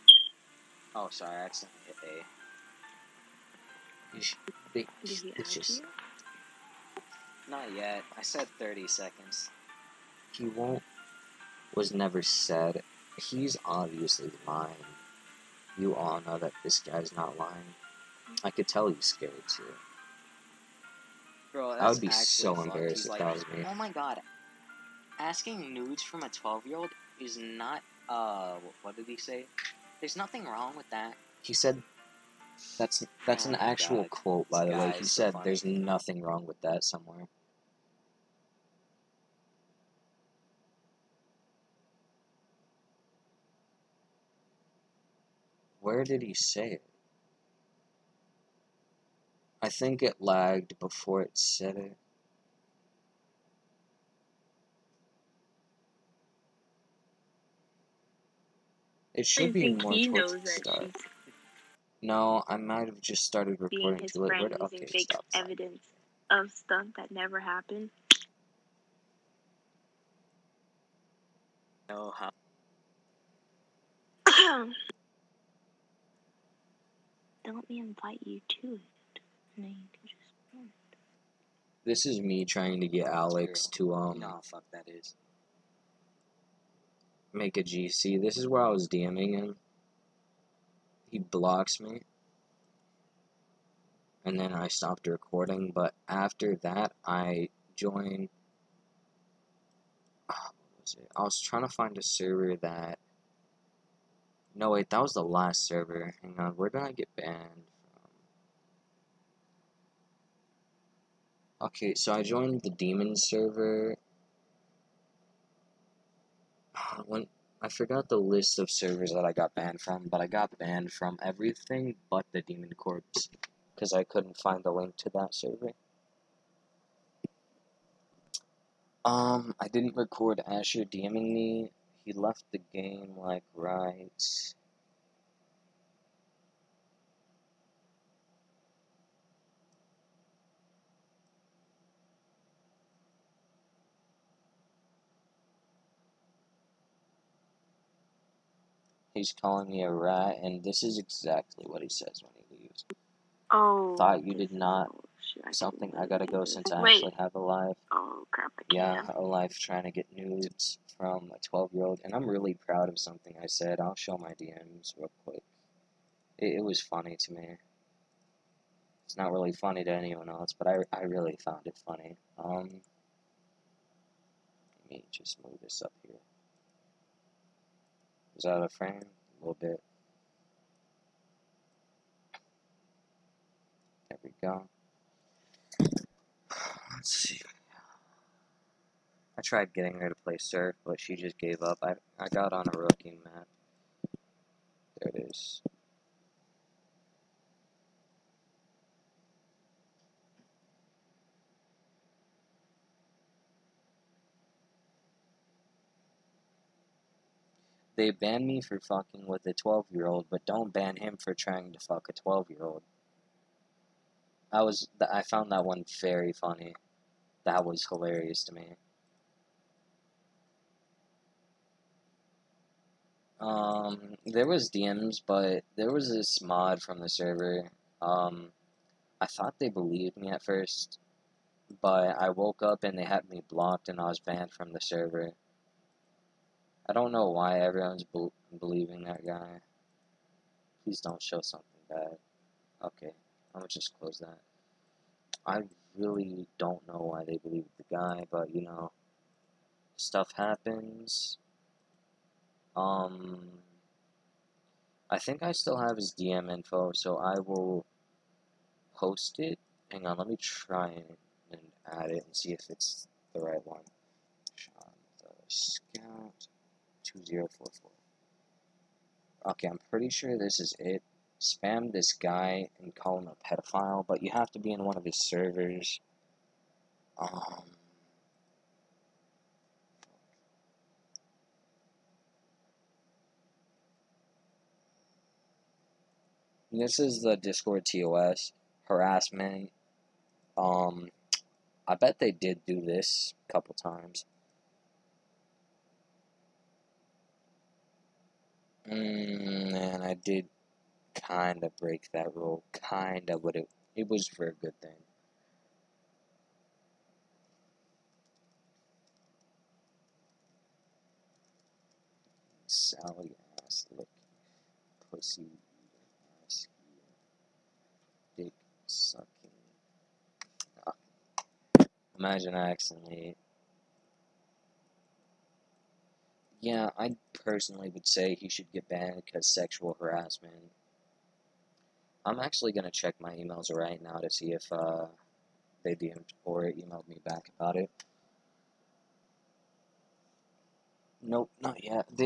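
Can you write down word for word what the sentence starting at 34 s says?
He said, so there's nothing wrong with that somewhere.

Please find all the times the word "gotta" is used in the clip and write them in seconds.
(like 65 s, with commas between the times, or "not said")
156 s.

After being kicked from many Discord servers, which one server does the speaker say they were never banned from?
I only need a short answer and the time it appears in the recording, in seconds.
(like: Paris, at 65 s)
Demon Corps, at 122 s.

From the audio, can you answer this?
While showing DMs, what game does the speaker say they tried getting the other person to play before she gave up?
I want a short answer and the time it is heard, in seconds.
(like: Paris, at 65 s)
Surf, at 190 s.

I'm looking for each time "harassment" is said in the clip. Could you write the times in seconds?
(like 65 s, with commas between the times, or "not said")
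288 s, 329 s.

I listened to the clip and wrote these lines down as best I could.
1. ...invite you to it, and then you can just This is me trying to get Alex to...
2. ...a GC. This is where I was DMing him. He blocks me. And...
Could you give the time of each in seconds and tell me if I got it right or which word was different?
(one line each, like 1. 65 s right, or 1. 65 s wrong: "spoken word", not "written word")
1. 77 s right
2. 87 s right.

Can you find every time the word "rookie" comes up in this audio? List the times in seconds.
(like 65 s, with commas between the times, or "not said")
192 s.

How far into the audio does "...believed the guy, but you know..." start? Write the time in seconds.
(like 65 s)
247 s.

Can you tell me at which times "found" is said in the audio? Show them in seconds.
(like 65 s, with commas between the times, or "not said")
171 s, 215 s.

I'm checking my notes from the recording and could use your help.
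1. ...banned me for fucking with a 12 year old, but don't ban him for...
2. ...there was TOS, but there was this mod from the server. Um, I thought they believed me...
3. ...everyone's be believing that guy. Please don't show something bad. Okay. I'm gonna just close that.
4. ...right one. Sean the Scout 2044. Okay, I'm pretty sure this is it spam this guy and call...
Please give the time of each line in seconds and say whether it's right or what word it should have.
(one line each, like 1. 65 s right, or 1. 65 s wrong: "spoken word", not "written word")
1. 208 s right
2. 224 s wrong: "DMs", not "TOS"
3. 237 s right
4. 263 s right.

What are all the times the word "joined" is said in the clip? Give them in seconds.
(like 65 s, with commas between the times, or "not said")
97 s, 112 s.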